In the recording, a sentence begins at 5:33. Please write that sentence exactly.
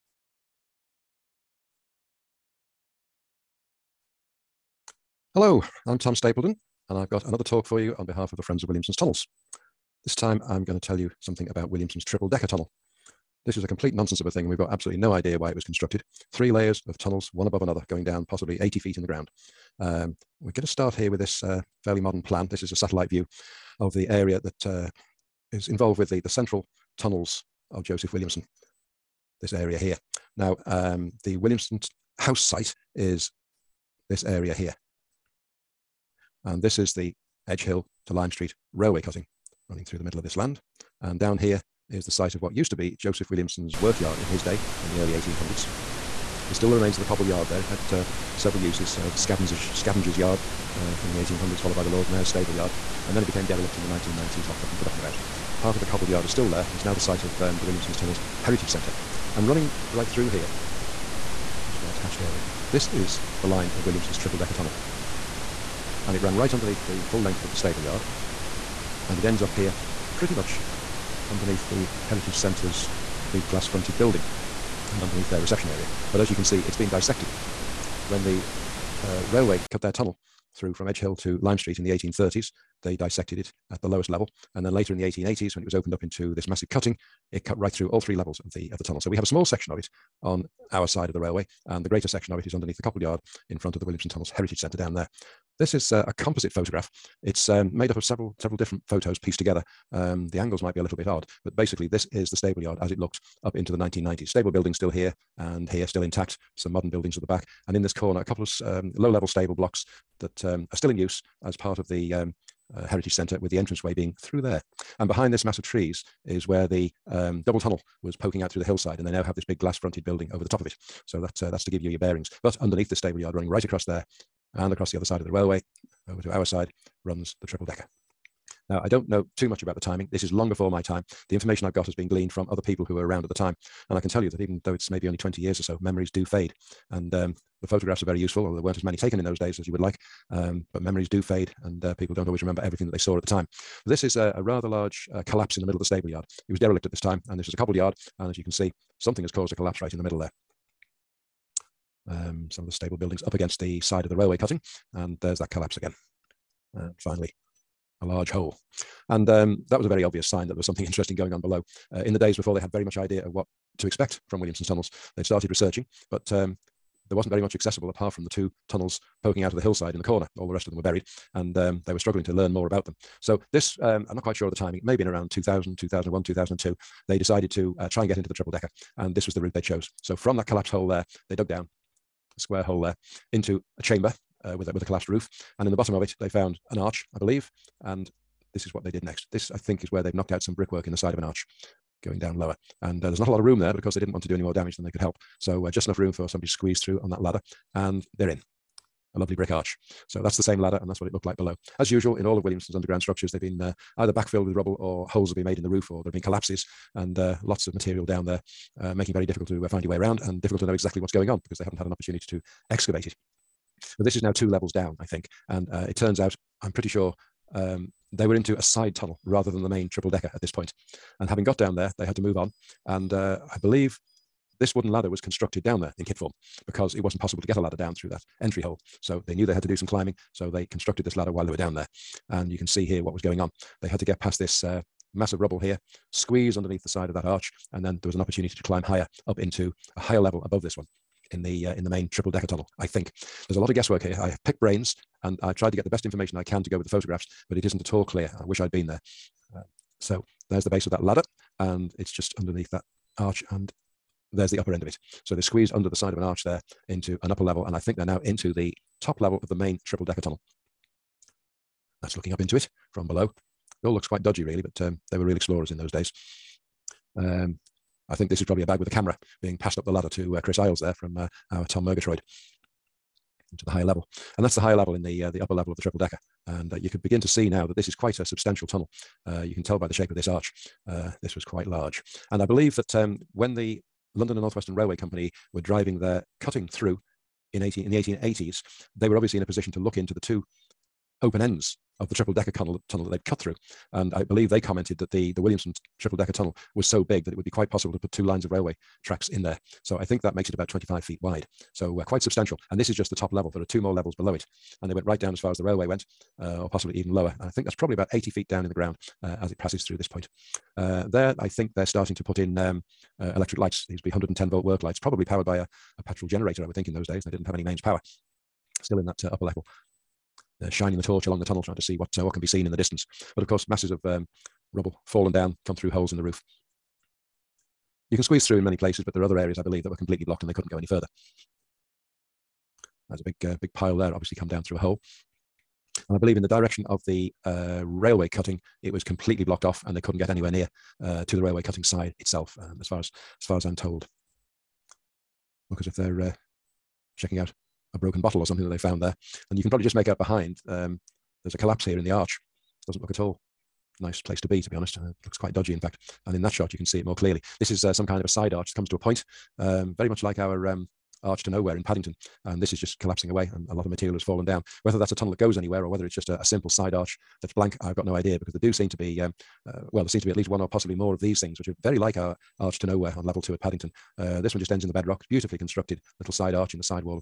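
There's a big, uh, big pile there, obviously come down through a hole.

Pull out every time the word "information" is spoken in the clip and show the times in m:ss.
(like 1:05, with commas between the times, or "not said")
2:11, 4:06.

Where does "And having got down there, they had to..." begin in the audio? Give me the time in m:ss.
3:41.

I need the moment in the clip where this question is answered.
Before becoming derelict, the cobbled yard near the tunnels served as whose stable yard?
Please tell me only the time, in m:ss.
0:51.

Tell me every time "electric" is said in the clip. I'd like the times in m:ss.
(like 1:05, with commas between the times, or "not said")
5:13.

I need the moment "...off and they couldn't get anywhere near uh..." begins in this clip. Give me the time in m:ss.
5:39.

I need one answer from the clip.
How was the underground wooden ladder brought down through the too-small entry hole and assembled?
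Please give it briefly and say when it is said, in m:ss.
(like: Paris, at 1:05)
In kit form, at 3:45.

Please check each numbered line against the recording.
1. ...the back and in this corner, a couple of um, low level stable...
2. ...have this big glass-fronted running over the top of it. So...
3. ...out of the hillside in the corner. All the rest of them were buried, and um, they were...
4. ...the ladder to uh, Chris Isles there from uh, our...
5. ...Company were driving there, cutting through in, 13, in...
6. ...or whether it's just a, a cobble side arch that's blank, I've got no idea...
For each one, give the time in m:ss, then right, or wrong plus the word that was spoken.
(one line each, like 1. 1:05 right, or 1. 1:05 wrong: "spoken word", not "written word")
1. 1:47 right
2. 1:59 wrong: "building", not "running"
3. 2:49 right
4. 4:29 right
5. 4:44 wrong: "18", not "13"
6. 6:05 wrong: "simple", not "cobble".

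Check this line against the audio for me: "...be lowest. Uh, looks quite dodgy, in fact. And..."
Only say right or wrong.
wrong.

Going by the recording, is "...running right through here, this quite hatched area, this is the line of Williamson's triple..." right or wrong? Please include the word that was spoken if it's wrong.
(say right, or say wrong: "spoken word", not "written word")
wrong: "white", not "quite".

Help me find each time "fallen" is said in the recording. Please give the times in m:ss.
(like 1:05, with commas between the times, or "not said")
5:25, 6:04.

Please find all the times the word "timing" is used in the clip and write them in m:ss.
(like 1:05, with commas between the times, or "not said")
2:09, 2:54.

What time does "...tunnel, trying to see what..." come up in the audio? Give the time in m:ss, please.
5:21.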